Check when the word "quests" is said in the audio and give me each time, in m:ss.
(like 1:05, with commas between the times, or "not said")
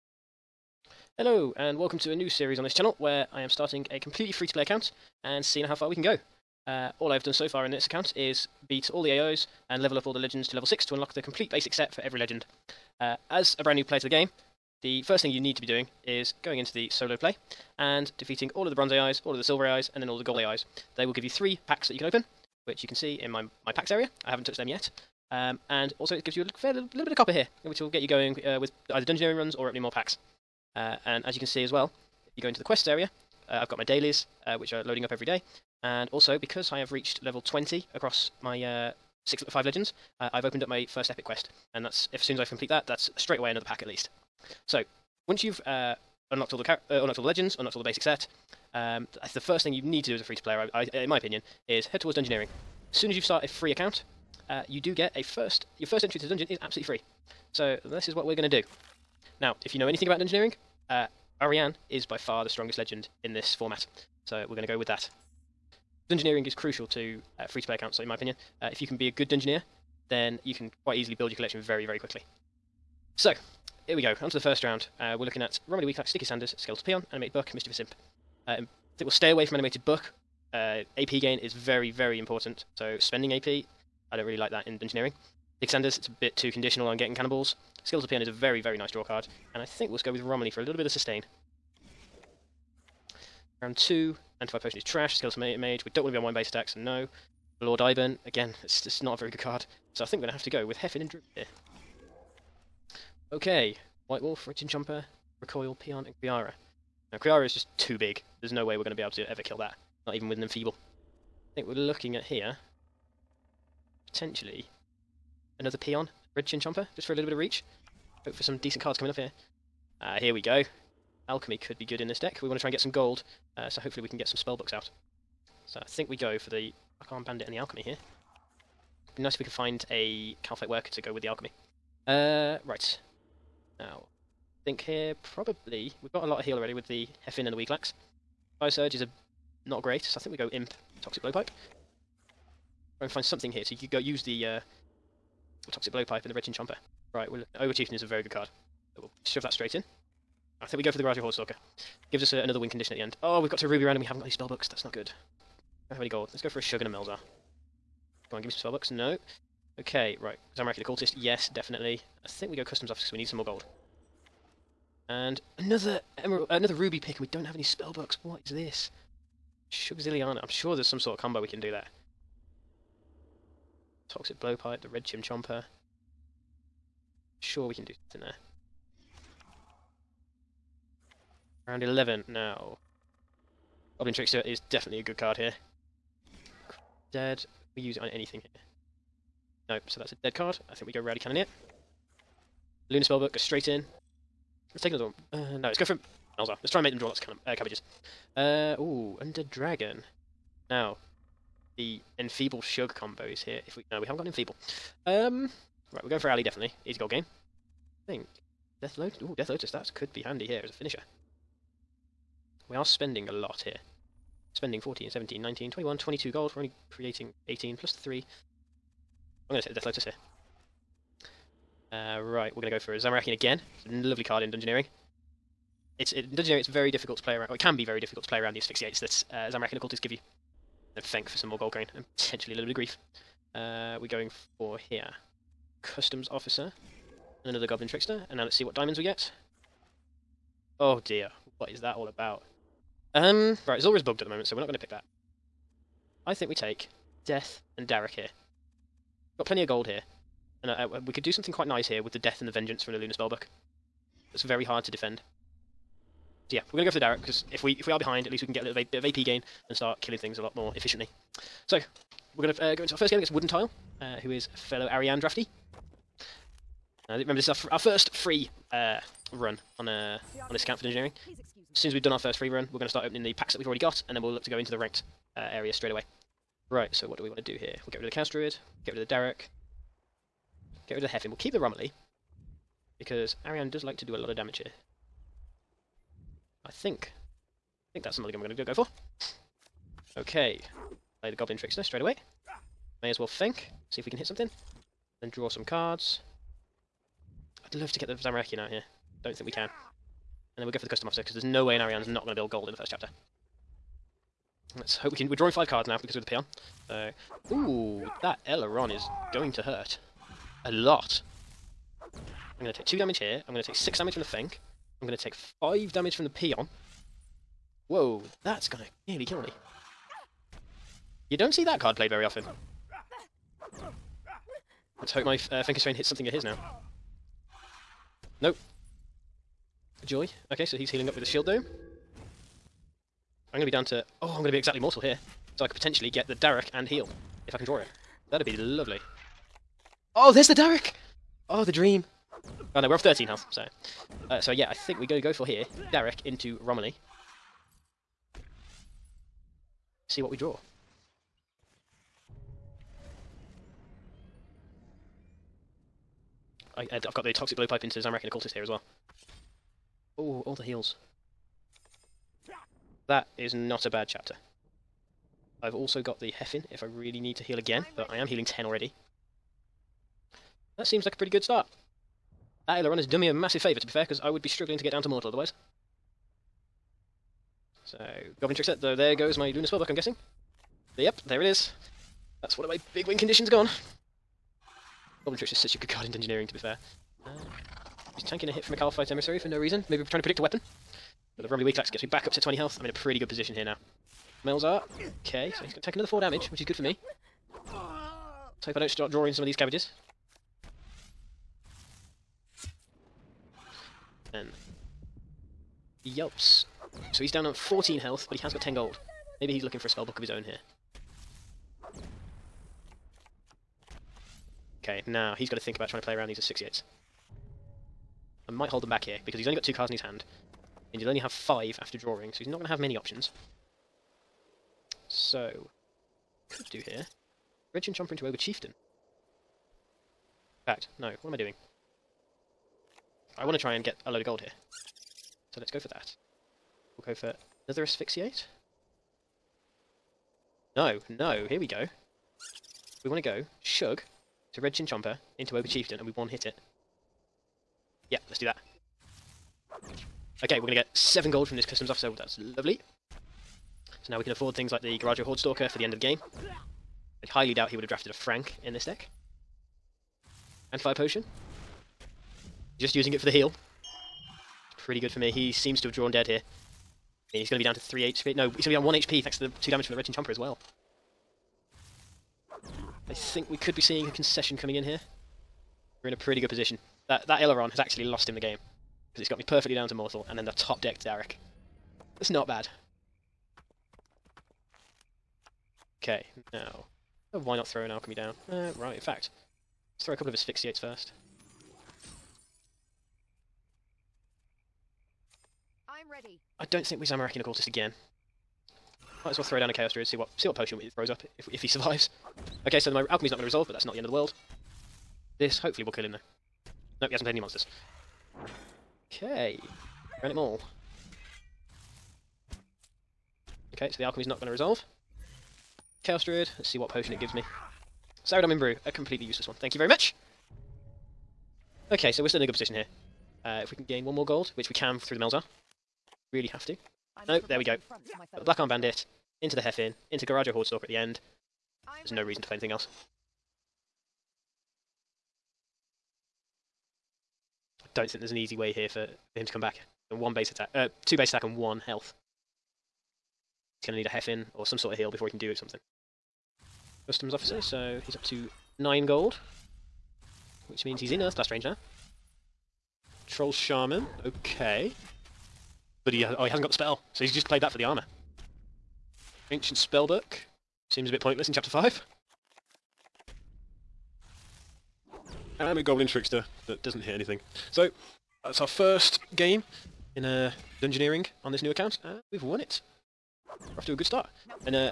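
0:32, 0:41.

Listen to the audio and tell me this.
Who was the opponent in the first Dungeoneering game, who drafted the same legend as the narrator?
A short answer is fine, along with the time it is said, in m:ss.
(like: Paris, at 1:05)
Wooden Tile, at 4:23.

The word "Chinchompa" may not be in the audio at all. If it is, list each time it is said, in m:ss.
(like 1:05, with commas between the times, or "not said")
1:44, 1:56, 2:26, 2:55, 7:07.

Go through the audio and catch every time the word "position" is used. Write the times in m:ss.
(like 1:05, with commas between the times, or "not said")
6:33, 7:56, 8:42.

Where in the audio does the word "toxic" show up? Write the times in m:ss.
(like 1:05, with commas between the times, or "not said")
2:21, 2:25, 2:54, 5:57.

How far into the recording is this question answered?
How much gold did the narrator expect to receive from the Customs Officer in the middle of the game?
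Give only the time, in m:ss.
7:30.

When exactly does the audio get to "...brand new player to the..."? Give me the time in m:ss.
0:13.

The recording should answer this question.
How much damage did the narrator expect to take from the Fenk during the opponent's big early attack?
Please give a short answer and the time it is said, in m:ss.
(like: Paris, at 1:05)
6, at 5:13.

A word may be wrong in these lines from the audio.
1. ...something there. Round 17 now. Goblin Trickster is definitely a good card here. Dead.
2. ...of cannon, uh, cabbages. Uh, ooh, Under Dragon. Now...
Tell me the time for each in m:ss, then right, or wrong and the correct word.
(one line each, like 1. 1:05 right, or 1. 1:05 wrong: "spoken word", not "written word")
1. 2:58 wrong: "11", not "17"
2. 3:17 right.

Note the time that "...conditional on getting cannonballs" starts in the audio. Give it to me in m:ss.
1:26.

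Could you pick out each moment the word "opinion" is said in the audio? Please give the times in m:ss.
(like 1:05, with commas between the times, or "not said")
0:51, 1:08.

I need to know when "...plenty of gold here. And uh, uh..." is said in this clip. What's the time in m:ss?
4:09.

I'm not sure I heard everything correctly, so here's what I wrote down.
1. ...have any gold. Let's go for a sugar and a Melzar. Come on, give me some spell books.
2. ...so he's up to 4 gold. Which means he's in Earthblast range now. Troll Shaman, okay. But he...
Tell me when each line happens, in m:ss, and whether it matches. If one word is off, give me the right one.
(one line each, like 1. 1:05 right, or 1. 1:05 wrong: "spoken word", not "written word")
1. 2:35 right
2. 9:07 wrong: "9", not "4".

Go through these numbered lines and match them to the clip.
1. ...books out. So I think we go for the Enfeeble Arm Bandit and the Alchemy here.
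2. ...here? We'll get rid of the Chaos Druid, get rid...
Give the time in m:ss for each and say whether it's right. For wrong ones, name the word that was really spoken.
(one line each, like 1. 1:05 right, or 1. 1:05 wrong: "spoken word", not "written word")
1. 2:04 wrong: "Black", not "Enfeeble"
2. 4:37 right.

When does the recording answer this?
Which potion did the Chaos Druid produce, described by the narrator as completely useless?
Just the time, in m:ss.
8:38.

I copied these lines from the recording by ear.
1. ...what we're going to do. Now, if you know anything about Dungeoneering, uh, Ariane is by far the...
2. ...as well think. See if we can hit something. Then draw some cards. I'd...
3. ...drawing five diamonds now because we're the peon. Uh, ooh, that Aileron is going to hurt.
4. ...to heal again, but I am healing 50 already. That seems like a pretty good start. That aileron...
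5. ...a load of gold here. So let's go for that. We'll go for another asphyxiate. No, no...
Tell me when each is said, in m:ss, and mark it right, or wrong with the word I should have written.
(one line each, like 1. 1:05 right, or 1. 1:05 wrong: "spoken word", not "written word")
1. 0:58 right
2. 4:53 right
3. 5:05 wrong: "cards", not "diamonds"
4. 6:07 wrong: "10", not "50"
5. 7:14 right.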